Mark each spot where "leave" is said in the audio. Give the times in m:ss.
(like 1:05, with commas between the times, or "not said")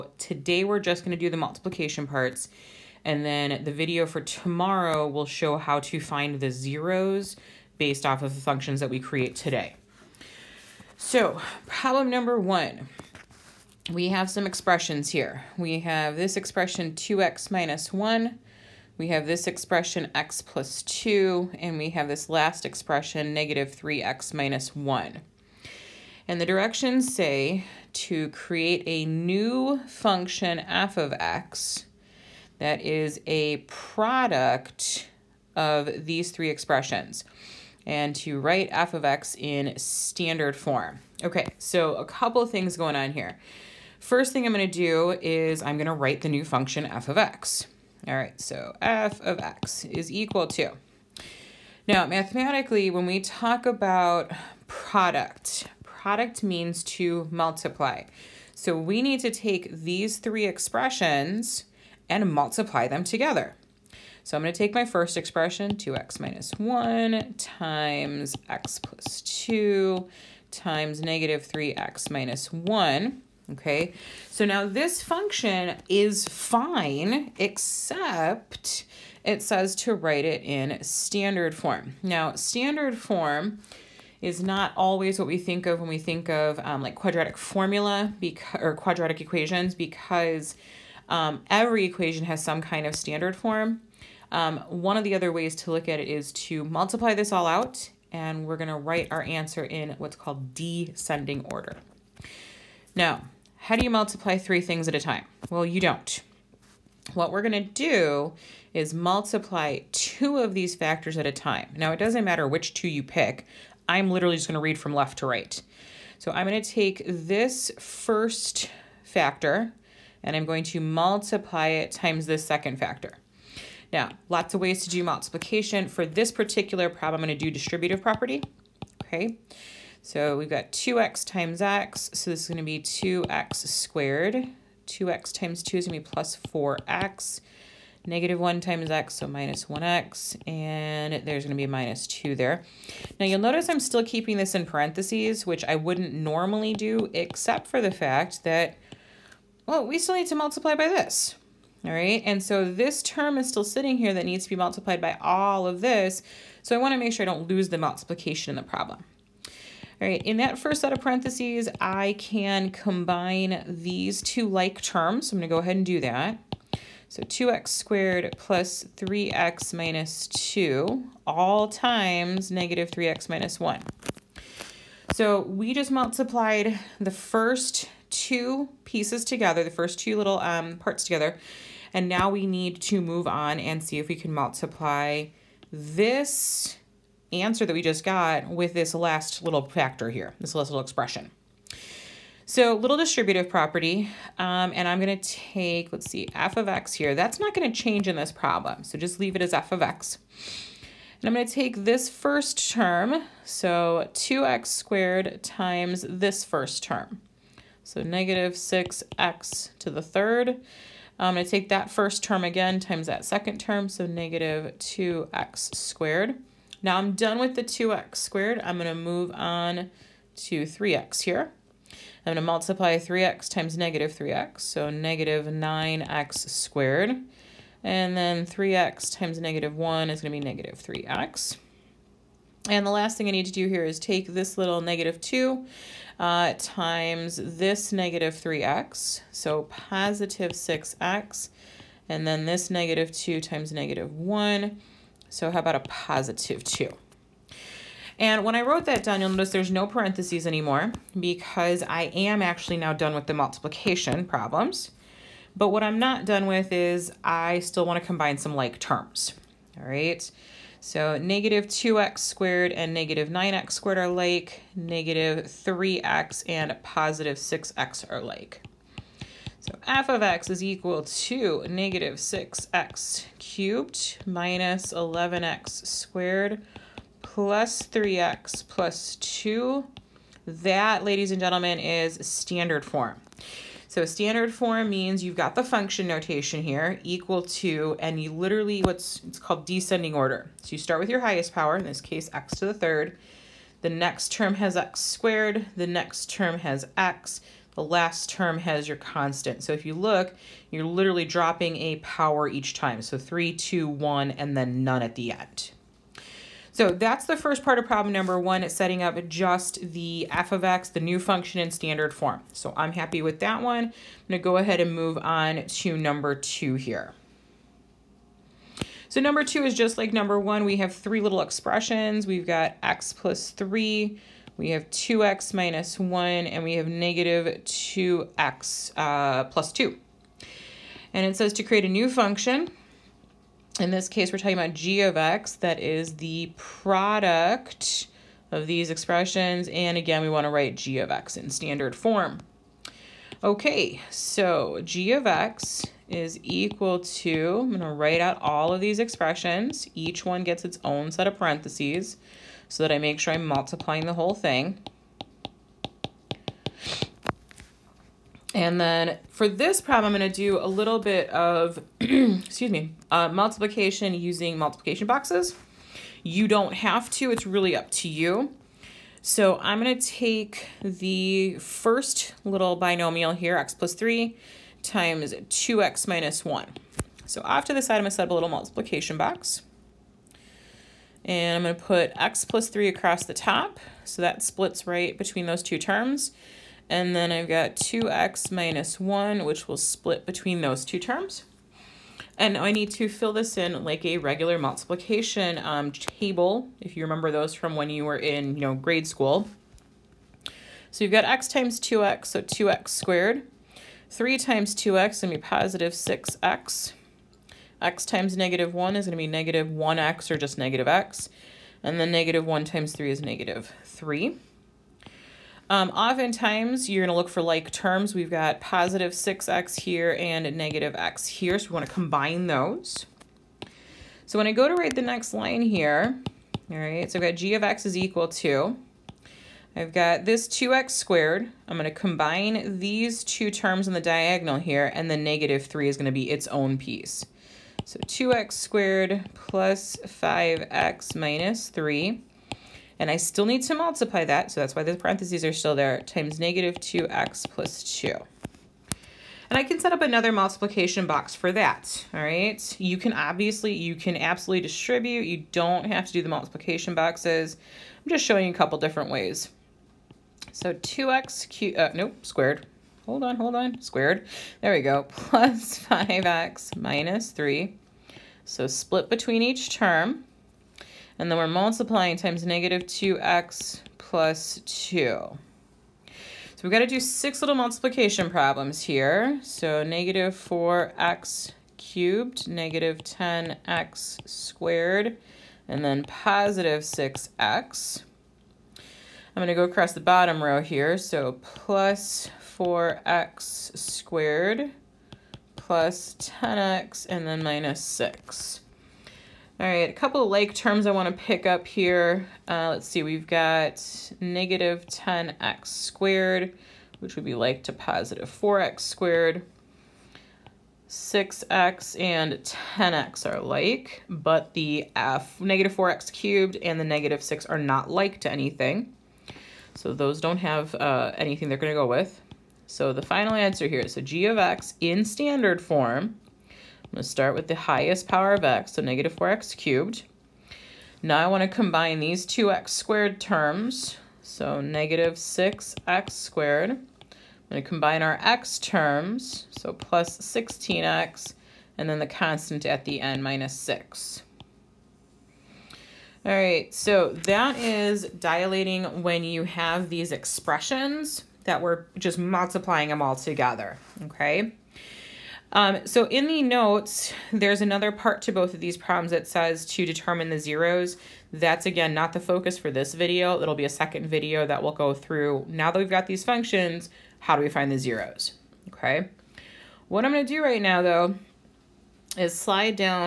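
3:19.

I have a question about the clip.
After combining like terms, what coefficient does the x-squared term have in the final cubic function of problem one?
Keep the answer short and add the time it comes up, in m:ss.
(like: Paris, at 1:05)
-11, at 4:34.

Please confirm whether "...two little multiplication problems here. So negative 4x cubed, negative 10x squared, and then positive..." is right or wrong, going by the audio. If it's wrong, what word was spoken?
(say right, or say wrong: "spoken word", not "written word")
wrong: "six", not "two".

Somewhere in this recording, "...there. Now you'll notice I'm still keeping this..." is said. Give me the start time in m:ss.
2:22.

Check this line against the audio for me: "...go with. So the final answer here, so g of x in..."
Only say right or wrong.
right.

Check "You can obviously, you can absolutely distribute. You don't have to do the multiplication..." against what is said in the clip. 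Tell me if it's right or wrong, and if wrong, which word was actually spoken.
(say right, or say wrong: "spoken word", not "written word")
right.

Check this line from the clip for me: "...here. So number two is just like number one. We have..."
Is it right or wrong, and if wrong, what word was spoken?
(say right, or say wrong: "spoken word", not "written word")
right.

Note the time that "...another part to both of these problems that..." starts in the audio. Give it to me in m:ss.
9:17.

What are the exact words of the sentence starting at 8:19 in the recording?
All right, a couple of like terms I want to pick up here.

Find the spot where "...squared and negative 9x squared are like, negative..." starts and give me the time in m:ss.
4:22.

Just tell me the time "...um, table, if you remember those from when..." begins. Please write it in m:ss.
6:35.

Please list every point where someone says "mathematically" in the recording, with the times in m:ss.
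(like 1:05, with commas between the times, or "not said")
0:52.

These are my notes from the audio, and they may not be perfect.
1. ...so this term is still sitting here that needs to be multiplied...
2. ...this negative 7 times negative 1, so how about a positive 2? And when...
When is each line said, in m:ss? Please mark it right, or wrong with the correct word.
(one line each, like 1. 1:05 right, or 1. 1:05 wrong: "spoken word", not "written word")
1. 2:32 right
2. 4:02 wrong: "2", not "7".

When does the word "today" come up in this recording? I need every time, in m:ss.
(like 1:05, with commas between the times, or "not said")
0:00, 0:09.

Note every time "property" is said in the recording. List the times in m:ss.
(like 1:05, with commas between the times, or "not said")
2:08, 3:13.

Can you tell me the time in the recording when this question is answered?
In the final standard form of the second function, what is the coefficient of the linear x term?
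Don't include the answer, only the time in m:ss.
8:59.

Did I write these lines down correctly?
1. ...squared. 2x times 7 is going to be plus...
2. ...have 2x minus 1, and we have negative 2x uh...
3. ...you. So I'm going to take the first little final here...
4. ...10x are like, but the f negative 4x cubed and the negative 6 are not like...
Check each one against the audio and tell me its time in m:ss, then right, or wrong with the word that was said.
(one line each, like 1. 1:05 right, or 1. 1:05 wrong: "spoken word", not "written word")
1. 2:13 wrong: "2", not "7"
2. 5:24 right
3. 6:08 wrong: "binomial", not "final"
4. 8:32 right.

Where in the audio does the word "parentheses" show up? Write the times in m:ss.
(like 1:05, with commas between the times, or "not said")
2:24, 2:41, 4:09, 5:51, 7:24.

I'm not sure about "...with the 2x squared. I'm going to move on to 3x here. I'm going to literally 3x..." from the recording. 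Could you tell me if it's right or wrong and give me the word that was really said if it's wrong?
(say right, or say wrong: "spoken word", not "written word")
wrong: "multiply", not "literally".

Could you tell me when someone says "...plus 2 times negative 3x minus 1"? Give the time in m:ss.
1:08.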